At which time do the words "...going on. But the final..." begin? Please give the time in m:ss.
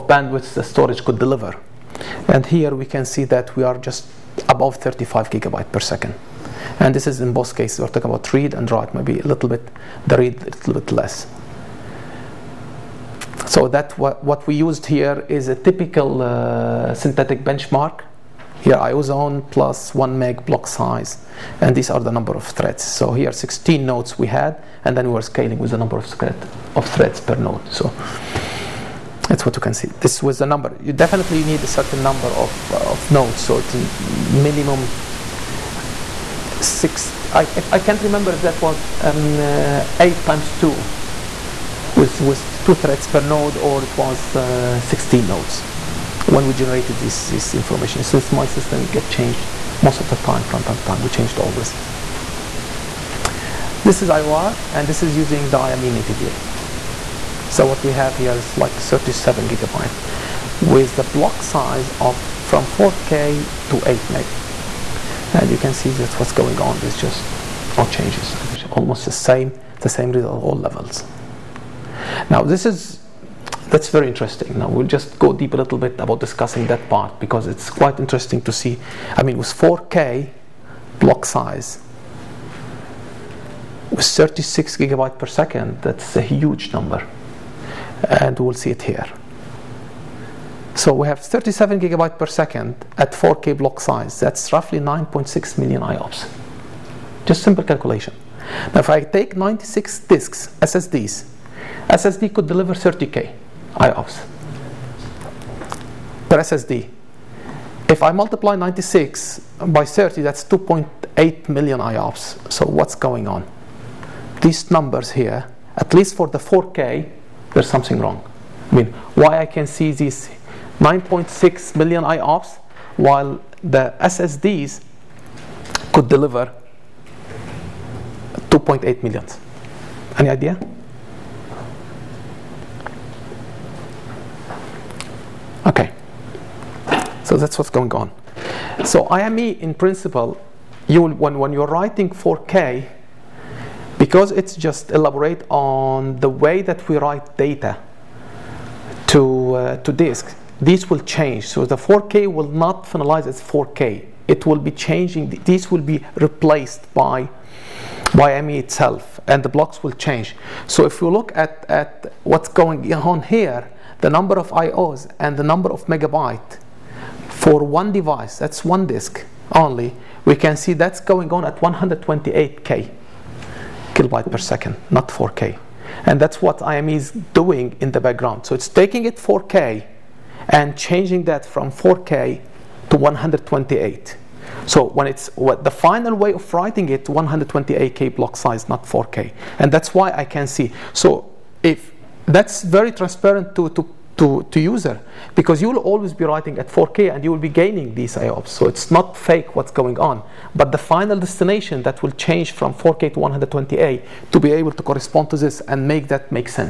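3:19.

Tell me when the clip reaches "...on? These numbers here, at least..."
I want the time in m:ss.
1:53.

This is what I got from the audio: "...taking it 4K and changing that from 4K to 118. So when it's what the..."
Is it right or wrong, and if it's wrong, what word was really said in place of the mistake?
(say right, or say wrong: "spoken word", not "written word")
wrong: "128", not "118".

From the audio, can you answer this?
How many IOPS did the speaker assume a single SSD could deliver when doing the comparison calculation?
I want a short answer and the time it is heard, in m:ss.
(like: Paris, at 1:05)
30K, at 1:42.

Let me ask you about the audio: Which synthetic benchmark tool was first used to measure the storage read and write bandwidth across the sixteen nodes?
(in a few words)
IOZone.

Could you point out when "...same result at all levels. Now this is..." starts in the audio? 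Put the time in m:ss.
1:09.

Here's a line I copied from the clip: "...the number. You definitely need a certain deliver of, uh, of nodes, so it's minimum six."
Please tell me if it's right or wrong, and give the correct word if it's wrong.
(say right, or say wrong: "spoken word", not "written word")
wrong: "number", not "deliver".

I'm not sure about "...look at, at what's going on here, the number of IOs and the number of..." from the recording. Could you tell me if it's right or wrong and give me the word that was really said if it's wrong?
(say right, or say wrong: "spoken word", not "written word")
right.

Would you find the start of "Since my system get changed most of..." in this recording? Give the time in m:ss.
0:48.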